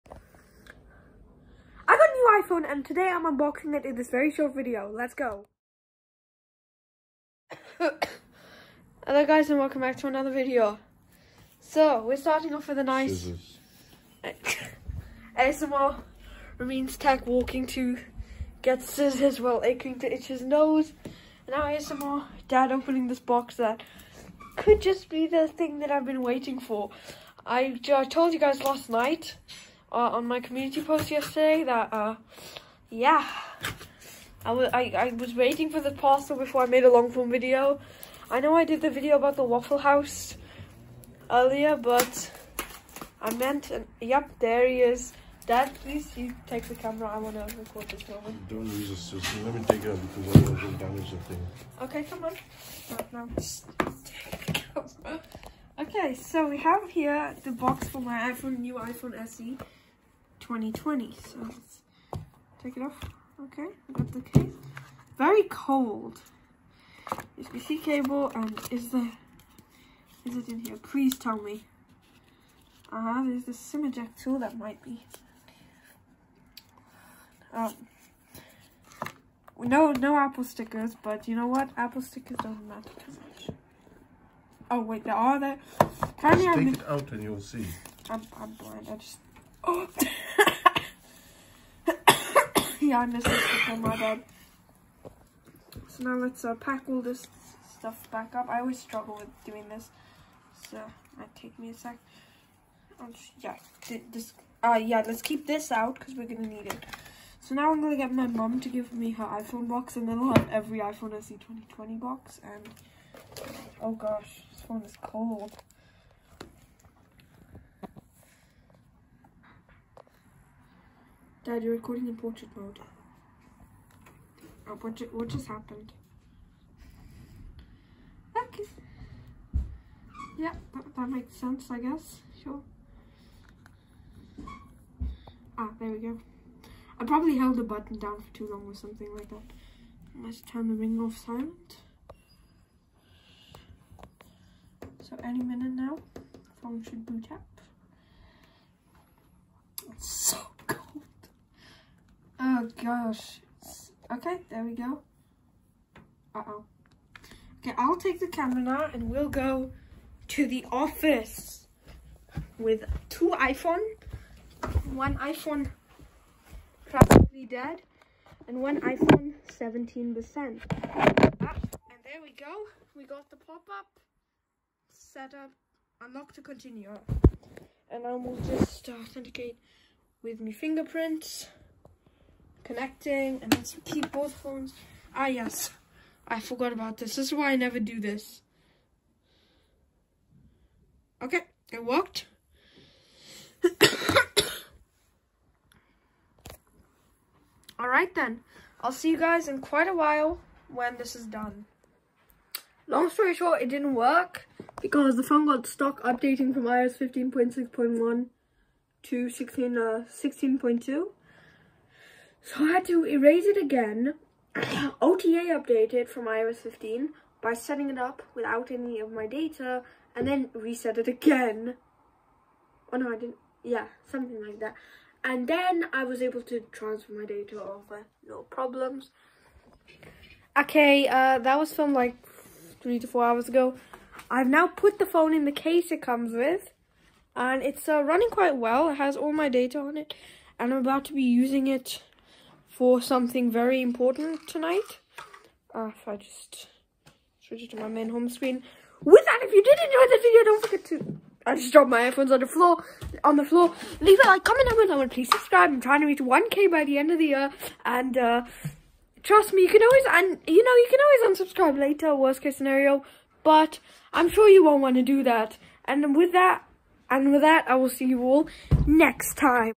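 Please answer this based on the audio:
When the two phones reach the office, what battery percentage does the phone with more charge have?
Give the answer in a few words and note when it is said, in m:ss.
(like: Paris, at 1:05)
17%, at 2:49.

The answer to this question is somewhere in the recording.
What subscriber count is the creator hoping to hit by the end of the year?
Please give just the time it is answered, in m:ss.
4:16.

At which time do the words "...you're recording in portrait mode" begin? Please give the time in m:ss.
2:01.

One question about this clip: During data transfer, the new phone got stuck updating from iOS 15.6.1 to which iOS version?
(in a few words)
16.2.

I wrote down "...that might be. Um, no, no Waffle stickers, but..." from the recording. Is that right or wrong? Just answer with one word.
wrong.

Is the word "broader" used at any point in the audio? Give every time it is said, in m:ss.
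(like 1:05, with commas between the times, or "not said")
not said.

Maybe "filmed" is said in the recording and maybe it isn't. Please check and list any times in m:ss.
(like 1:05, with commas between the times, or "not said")
3:51.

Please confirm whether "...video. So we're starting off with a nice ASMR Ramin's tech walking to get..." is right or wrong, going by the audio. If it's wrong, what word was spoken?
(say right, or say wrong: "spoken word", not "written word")
right.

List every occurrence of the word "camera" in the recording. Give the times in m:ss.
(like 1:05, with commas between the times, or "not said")
0:46, 0:54, 2:38.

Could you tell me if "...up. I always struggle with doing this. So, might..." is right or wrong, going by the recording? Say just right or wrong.
right.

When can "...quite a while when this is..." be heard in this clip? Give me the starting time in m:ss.
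3:19.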